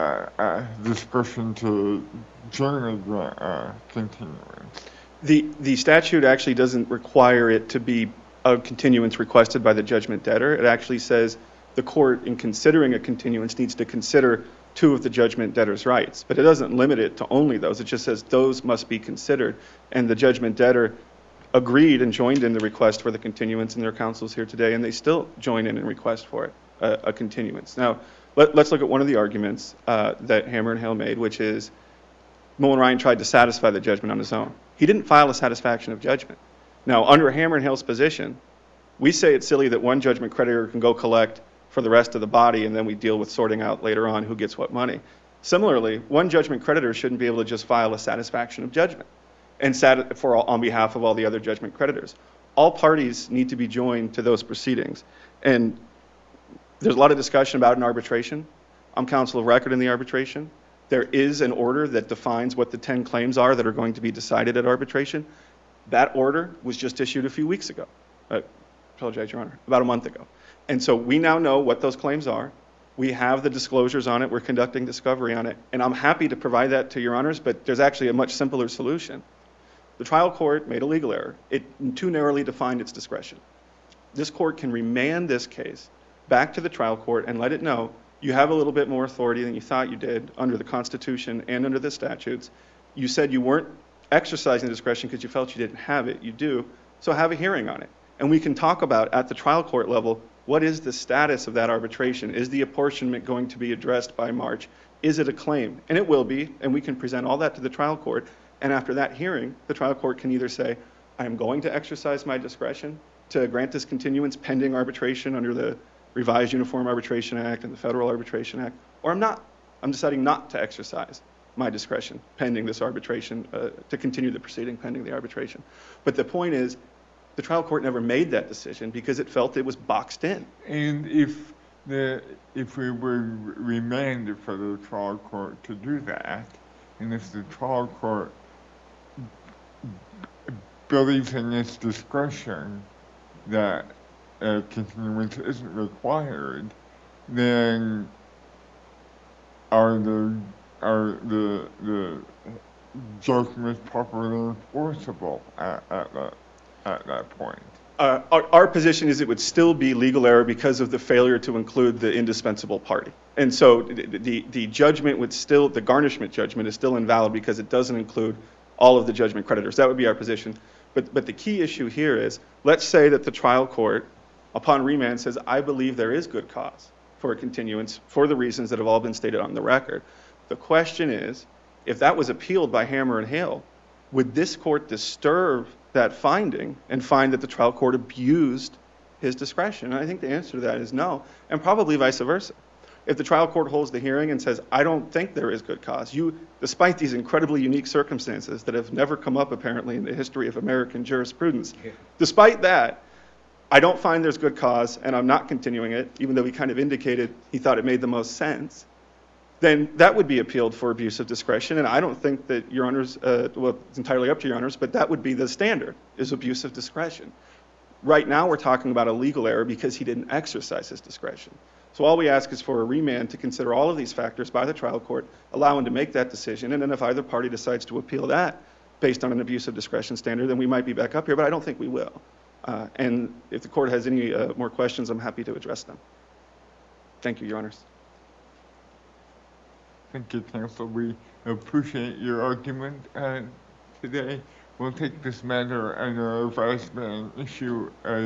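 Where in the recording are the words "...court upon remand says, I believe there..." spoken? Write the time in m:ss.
2:53.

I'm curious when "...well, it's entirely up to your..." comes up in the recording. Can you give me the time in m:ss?
3:33.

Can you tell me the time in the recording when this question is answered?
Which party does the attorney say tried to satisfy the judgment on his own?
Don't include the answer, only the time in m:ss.
0:32.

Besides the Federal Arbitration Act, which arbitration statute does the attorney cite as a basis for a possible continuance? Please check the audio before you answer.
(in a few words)
Revised Uniform Arbitration Act.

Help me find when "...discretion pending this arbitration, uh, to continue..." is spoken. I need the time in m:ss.
2:01.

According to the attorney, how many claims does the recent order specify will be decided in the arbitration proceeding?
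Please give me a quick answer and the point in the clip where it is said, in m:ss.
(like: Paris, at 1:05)
10, at 1:02.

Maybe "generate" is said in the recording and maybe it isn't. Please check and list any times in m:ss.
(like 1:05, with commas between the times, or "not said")
0:02.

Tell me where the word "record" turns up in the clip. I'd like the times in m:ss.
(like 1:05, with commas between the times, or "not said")
0:59, 2:59.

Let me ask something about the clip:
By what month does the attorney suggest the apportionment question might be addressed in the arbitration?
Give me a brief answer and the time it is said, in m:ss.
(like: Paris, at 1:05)
March, at 1:44.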